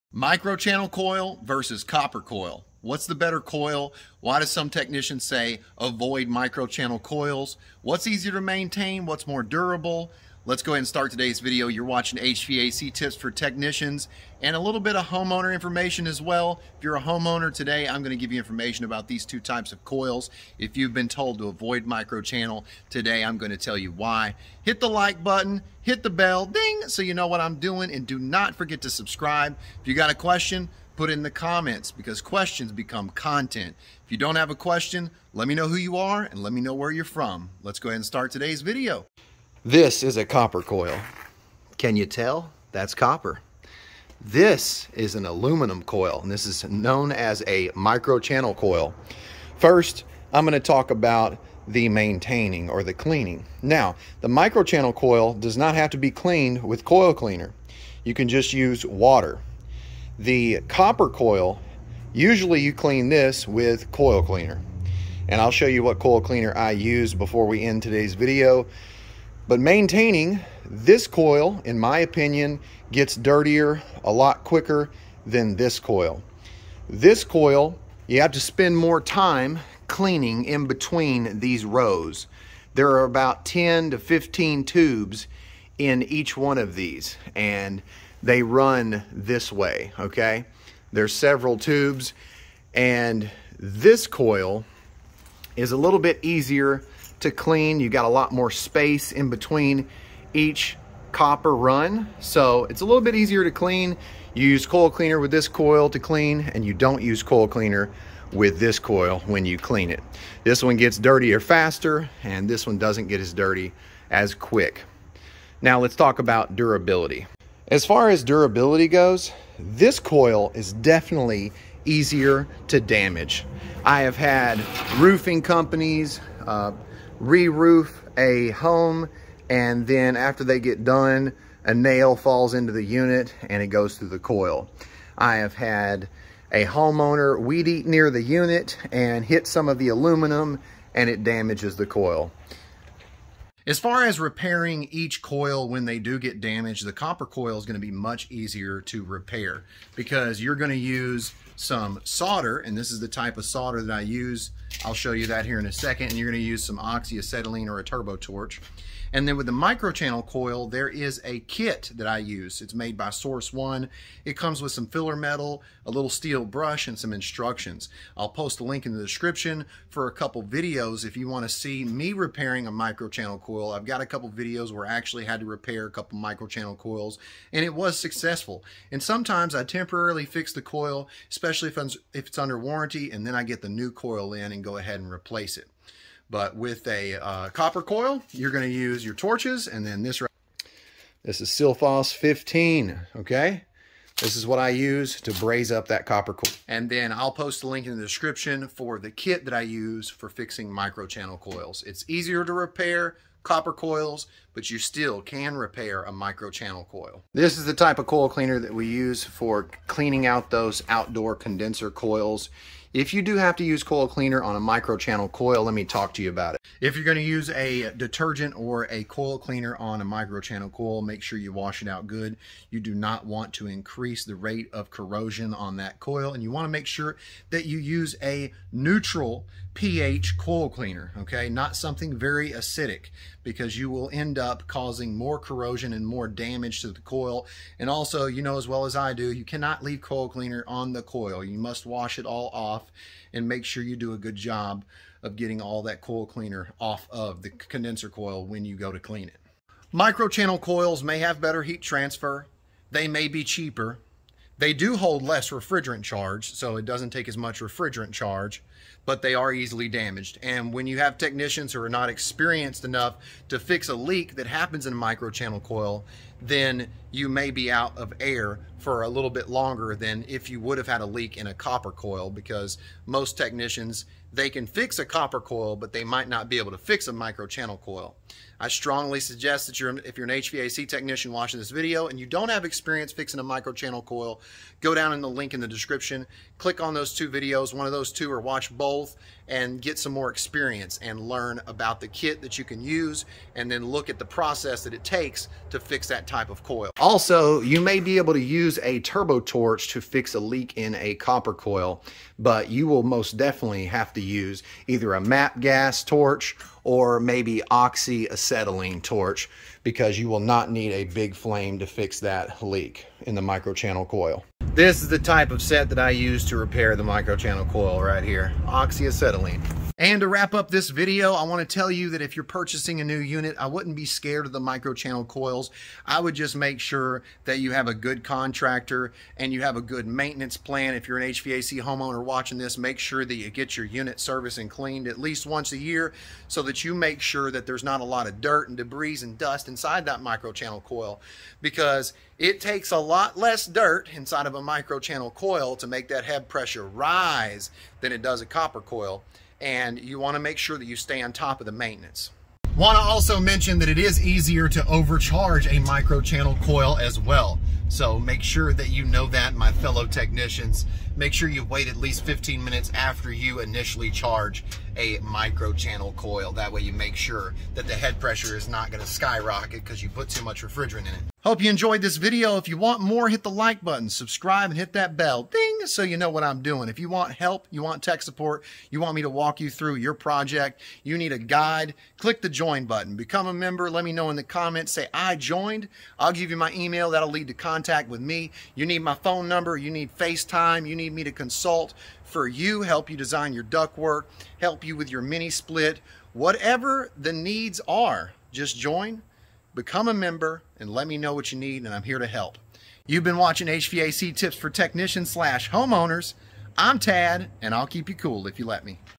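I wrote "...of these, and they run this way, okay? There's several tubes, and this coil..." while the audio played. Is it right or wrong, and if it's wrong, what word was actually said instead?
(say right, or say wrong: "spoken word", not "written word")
right.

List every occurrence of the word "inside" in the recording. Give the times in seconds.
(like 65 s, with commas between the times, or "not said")
339 s, 344 s.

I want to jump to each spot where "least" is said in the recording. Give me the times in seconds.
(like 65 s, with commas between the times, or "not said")
335 s, 361 s.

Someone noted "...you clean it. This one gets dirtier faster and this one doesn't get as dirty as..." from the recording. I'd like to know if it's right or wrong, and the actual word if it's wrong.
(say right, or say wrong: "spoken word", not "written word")
right.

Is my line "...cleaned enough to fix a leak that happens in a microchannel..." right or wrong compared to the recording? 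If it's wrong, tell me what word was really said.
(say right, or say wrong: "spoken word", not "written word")
wrong: "experienced", not "cleaned".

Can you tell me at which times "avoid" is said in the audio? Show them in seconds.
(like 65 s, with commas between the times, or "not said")
5 s, 21 s.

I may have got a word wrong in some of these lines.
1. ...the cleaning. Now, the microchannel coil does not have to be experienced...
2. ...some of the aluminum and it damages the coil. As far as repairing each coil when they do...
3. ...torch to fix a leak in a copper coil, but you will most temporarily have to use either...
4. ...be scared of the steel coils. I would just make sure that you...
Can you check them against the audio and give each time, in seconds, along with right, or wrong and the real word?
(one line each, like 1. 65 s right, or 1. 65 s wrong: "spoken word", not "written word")
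1. 52 s wrong: "cleaned", not "experienced"
2. 139 s right
3. 299 s wrong: "definitely", not "temporarily"
4. 323 s wrong: "microchannel", not "steel".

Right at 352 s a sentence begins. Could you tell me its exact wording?
Want to also mention that it is easier to overcharge a microchannel coil as well.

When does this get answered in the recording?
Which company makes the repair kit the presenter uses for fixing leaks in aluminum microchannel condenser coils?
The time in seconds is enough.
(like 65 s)
163 s.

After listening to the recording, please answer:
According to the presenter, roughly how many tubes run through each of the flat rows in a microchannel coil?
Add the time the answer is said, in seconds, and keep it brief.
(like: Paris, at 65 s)
10 to 15, at 83 s.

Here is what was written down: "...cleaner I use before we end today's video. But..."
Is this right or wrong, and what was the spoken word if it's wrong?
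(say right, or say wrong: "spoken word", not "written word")
right.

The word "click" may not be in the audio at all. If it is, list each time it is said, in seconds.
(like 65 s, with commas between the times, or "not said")
286 s, 382 s.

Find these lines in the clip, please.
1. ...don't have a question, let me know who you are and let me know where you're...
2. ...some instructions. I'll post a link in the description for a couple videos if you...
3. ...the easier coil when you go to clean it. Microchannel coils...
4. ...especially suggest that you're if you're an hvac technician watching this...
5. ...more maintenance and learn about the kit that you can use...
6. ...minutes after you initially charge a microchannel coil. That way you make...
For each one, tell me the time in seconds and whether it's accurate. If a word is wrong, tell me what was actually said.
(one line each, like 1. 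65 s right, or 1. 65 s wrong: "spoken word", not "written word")
1. 34 s right
2. 166 s right
3. 247 s wrong: "condenser", not "easier"
4. 278 s wrong: "strongly", not "especially"
5. 290 s wrong: "experience", not "maintenance"
6. 362 s right.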